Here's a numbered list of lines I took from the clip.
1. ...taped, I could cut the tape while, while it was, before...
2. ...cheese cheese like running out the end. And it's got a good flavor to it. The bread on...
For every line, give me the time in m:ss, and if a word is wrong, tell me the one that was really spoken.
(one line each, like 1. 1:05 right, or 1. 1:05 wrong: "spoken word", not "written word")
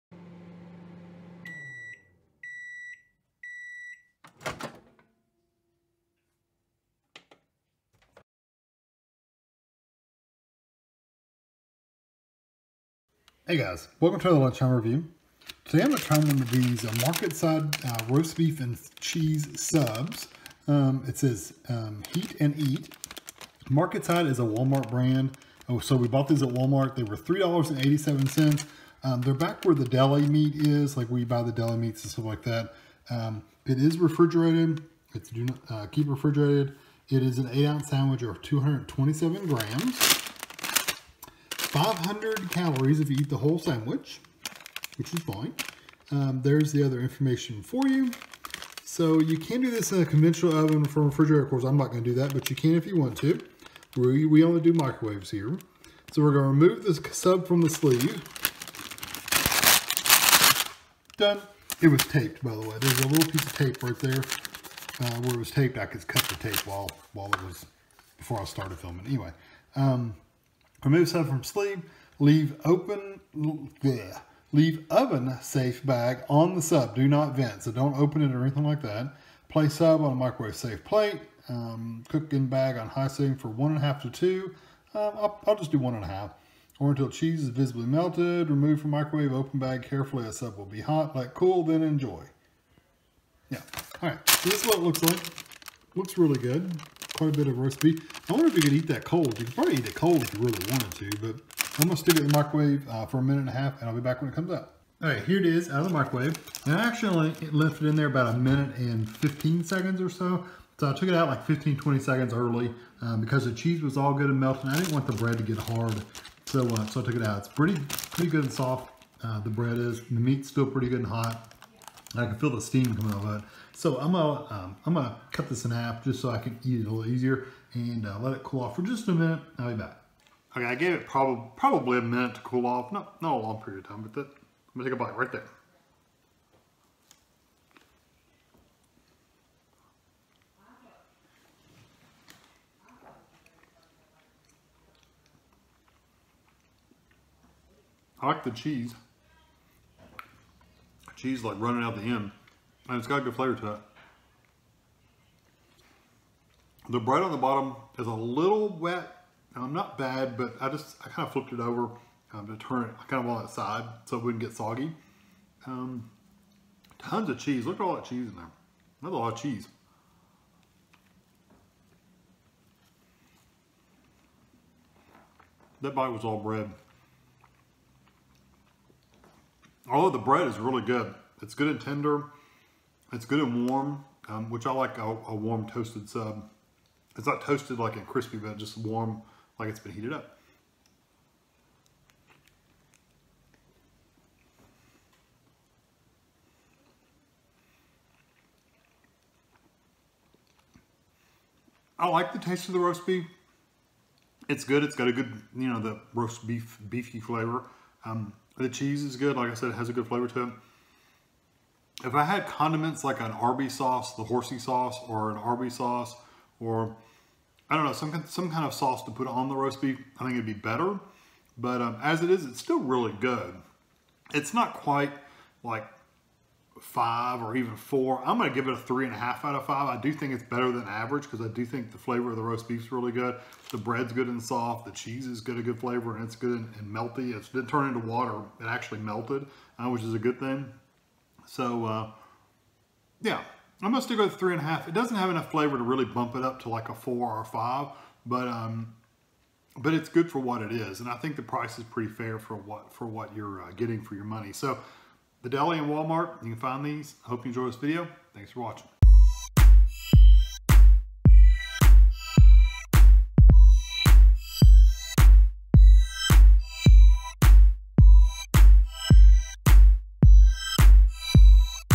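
1. 1:05 right
2. 2:28 right.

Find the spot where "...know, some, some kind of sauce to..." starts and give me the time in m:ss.
3:37.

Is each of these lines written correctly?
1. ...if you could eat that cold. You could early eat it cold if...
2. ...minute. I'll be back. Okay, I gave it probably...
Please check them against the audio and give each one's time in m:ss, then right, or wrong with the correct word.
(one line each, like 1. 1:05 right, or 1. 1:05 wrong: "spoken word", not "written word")
1. 1:38 wrong: "probably", not "early"
2. 2:09 right.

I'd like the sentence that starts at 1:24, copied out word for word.
Um, I'll, I'll just do one and a half or until cheese is visibly melted.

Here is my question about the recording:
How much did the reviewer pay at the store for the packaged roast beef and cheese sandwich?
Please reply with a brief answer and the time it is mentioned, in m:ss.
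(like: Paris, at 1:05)
$3.87, at 0:27.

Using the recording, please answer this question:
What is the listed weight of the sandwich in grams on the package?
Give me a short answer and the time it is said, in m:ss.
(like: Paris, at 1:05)
227 grams, at 0:38.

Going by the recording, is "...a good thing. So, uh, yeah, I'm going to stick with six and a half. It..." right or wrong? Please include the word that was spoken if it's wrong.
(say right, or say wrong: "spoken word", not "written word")
wrong: "three", not "six".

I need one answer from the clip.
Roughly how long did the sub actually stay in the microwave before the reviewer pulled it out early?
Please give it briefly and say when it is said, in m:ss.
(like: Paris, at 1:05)
1 minute 15 seconds, at 1:48.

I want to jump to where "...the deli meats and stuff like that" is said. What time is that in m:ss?
0:31.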